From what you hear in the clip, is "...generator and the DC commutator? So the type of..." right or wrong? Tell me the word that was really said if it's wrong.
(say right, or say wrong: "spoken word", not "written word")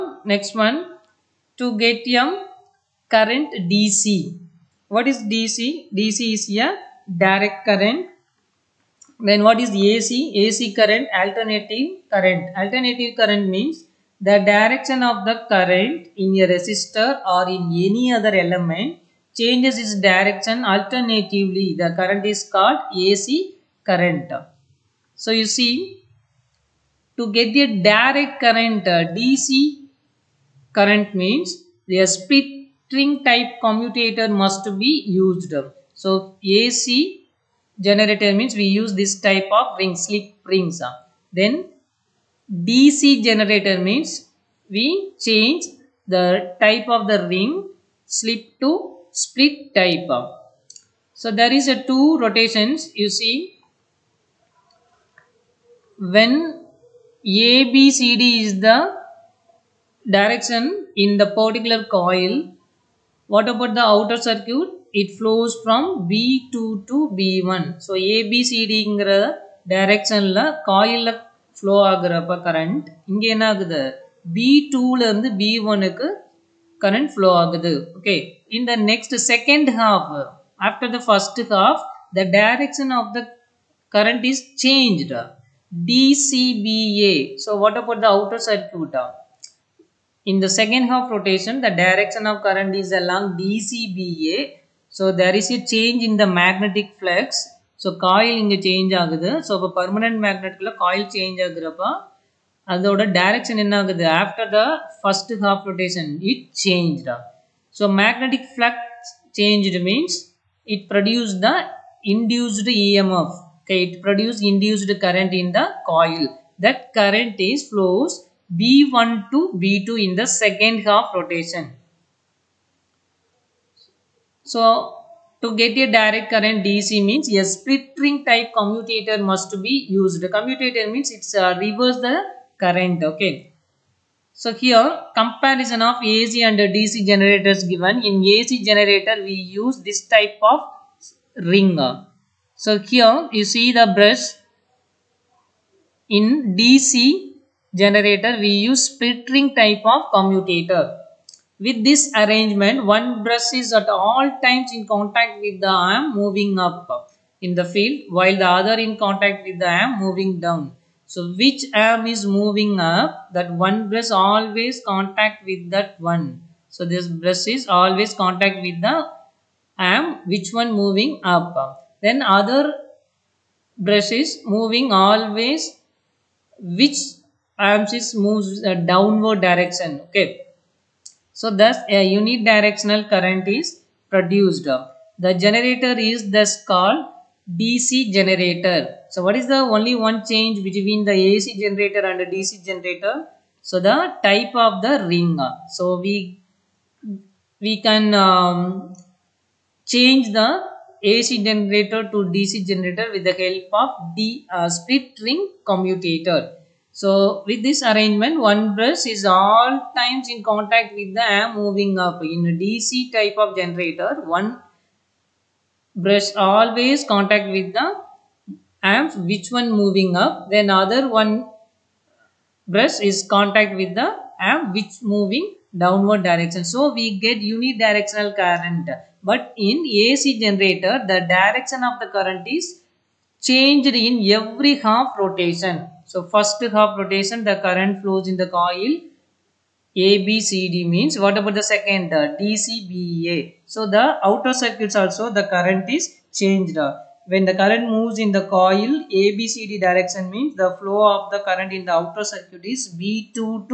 wrong: "generator", not "commutator".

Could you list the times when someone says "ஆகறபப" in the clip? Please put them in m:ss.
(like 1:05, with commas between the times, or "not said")
1:11, 1:41.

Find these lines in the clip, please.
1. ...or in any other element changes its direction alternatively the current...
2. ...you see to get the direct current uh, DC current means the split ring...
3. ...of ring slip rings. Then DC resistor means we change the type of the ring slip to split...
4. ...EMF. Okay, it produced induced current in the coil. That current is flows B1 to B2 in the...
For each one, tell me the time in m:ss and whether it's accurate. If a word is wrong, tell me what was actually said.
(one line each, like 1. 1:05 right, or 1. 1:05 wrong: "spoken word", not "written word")
1. 0:17 right
2. 0:25 right
3. 0:39 wrong: "generator", not "resistor"
4. 1:52 right.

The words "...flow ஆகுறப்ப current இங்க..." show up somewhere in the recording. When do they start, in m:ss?
1:11.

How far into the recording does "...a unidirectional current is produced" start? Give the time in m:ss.
3:01.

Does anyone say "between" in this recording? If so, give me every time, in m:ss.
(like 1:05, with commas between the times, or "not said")
3:10.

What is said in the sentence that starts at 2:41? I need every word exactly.
So which arm is moving up, that one brush always contact with that one.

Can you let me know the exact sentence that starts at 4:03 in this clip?
So the outer circuits also the current is changed.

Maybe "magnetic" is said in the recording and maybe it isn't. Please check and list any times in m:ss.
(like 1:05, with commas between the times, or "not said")
1:36, 1:47.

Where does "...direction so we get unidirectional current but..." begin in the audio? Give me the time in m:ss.
3:46.